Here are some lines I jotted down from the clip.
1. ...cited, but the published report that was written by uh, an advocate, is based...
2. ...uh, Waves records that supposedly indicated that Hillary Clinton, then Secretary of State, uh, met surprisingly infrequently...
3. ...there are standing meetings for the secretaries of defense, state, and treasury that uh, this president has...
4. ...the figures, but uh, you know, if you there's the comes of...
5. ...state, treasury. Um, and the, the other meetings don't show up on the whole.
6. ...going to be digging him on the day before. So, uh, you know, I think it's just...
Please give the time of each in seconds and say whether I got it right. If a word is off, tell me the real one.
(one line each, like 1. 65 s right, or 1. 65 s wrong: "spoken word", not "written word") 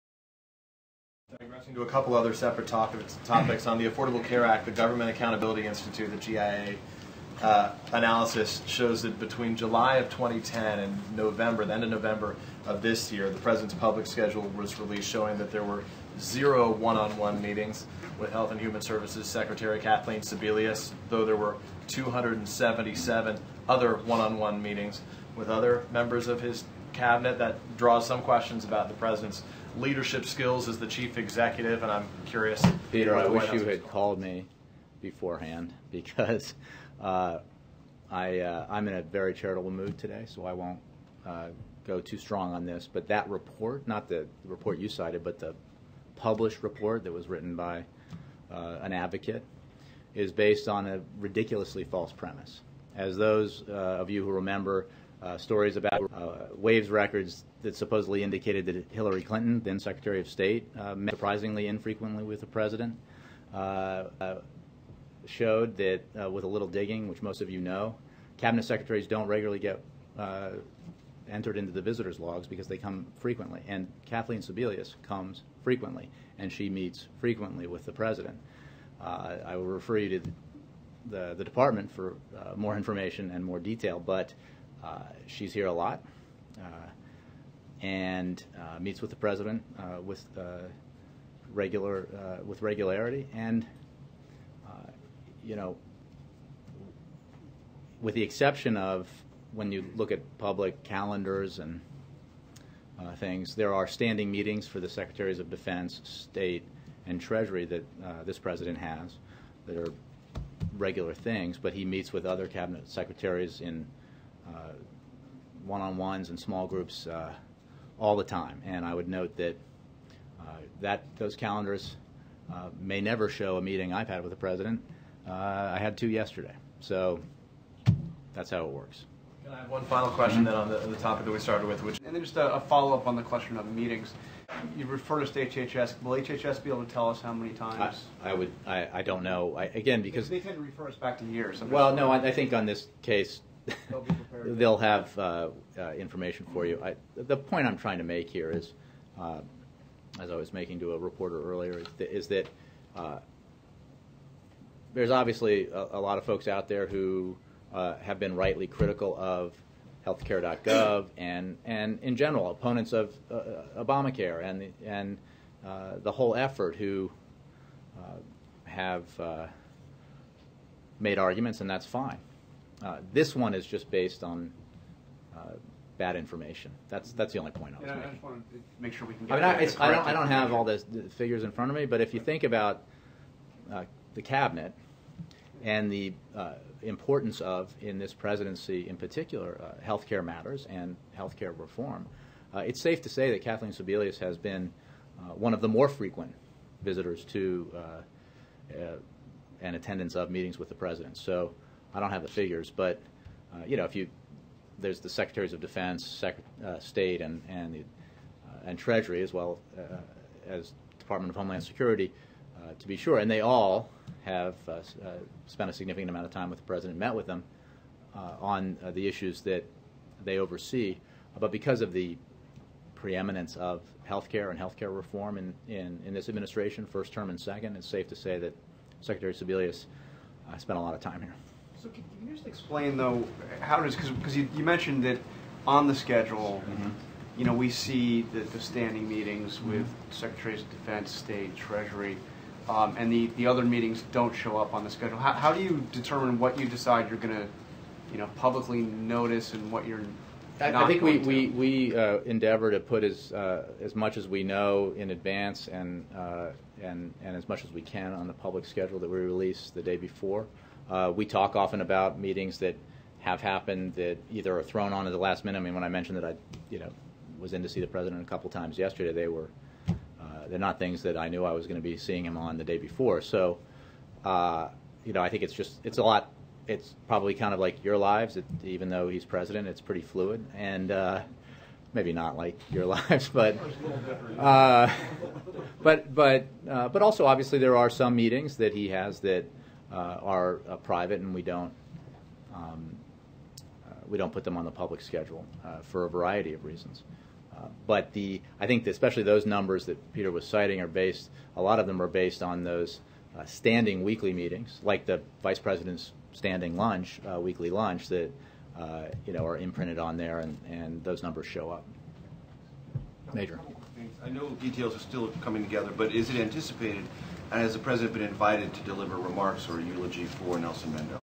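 1. 44 s right
2. 56 s right
3. 103 s right
4. 202 s wrong: "secretaries", not "comes"
5. 241 s wrong: "schedule", not "whole"
6. 271 s wrong: "seeing", not "digging".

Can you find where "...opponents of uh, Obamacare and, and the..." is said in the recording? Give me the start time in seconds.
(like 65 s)
162 s.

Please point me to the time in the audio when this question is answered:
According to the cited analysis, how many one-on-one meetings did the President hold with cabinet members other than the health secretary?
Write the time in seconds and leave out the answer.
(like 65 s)
21 s.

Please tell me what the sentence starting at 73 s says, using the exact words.
And Kathleen Sebelius comes frequently, and she meets frequently with the president.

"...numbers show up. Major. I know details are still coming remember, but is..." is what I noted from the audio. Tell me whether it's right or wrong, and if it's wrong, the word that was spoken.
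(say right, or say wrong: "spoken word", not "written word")
wrong: "together", not "remember".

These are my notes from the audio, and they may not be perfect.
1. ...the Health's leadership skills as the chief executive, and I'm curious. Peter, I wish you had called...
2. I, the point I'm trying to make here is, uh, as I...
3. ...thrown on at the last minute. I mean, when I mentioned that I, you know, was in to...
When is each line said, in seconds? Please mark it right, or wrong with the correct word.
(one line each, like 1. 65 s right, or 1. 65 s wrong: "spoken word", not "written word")
1. 28 s wrong: "President", not "Health"
2. 146 s right
3. 264 s right.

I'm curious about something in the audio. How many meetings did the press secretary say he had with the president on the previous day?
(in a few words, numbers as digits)
2.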